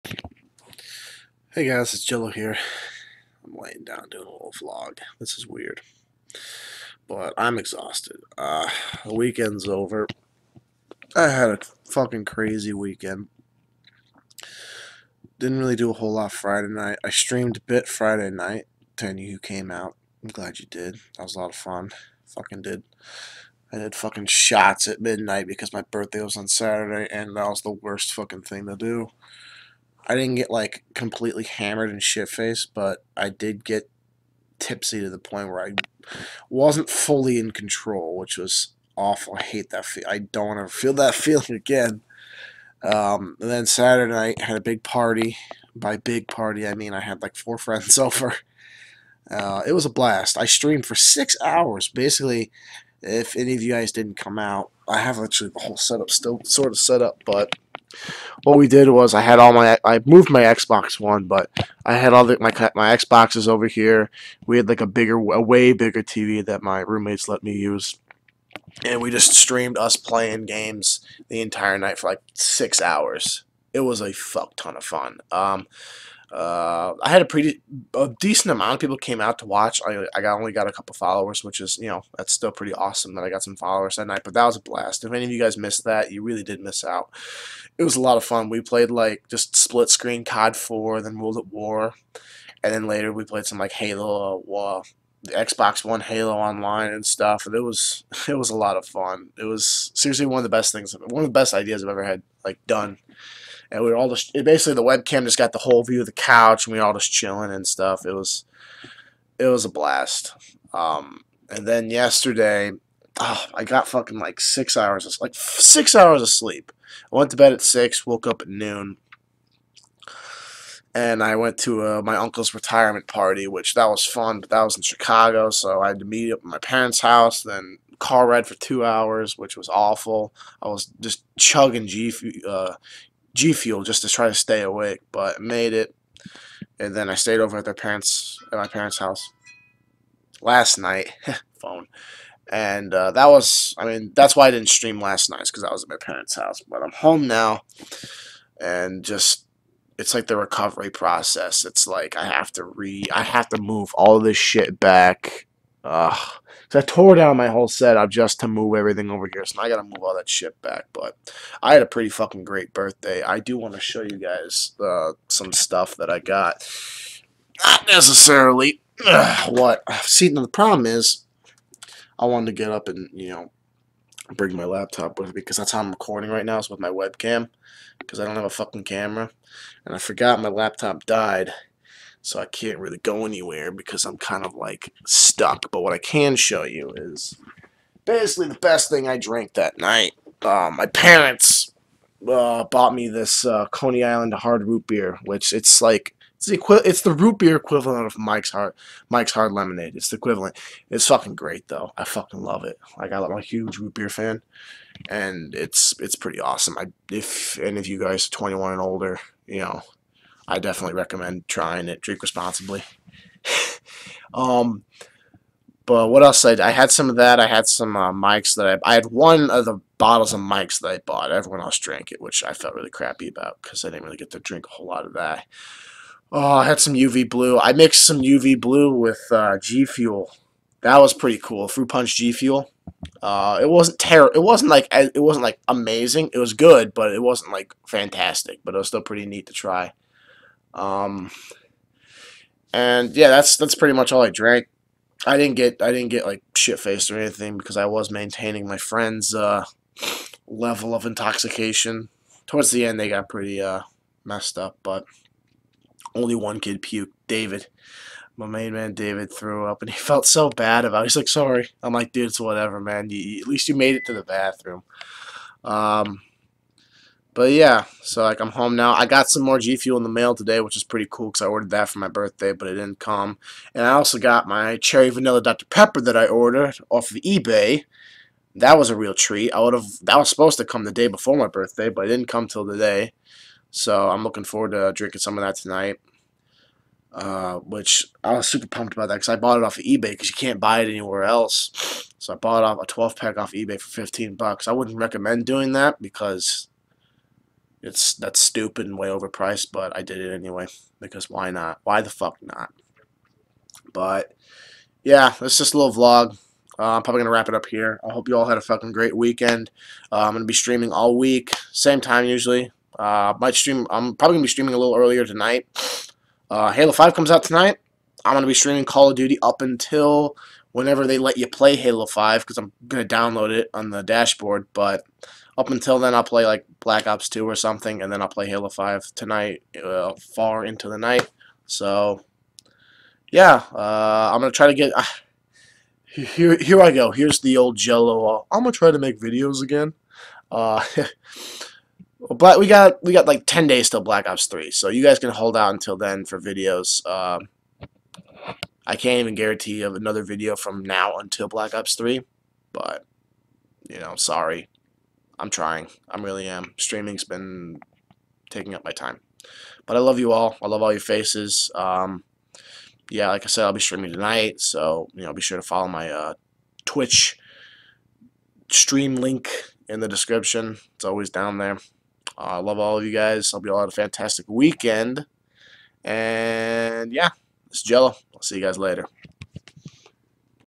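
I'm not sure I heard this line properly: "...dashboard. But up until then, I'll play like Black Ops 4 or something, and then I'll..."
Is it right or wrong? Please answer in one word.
wrong.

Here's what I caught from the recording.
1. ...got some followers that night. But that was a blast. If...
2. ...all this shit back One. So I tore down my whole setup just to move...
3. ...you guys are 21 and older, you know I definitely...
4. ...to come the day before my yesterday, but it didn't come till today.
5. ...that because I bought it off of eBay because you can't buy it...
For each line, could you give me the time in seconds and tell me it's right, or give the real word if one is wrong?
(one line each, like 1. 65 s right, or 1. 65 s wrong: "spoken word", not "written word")
1. 83 s right
2. 153 s wrong: "Ugh", not "One"
3. 207 s right
4. 280 s wrong: "birthday", not "yesterday"
5. 289 s right.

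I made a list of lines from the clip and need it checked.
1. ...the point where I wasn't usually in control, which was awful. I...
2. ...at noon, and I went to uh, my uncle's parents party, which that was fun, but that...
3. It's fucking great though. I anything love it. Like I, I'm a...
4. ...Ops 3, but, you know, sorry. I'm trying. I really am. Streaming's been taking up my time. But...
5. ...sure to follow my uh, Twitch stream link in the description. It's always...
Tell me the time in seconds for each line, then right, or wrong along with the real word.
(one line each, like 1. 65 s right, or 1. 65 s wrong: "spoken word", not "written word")
1. 35 s wrong: "fully", not "usually"
2. 118 s wrong: "retirement", not "parents"
3. 200 s wrong: "fucking", not "anything"
4. 351 s right
5. 365 s right.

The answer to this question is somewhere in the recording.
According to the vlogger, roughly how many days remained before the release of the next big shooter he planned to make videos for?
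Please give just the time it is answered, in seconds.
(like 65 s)
343 s.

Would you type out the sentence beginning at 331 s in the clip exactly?
So, yeah, uh, I'm going to try to get...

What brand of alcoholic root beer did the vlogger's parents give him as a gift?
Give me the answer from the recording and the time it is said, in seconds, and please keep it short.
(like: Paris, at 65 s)
Coney Island, at 193 s.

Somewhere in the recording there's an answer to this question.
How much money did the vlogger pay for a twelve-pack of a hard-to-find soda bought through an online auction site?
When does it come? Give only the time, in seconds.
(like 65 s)
293 s.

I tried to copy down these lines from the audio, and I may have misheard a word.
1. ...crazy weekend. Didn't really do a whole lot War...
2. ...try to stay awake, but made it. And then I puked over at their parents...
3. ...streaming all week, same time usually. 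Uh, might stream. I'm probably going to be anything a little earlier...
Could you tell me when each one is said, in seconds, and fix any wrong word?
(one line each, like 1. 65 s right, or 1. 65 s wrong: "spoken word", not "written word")
1. 12 s wrong: "Friday", not "War"
2. 134 s wrong: "stayed", not "puked"
3. 310 s wrong: "streaming", not "anything".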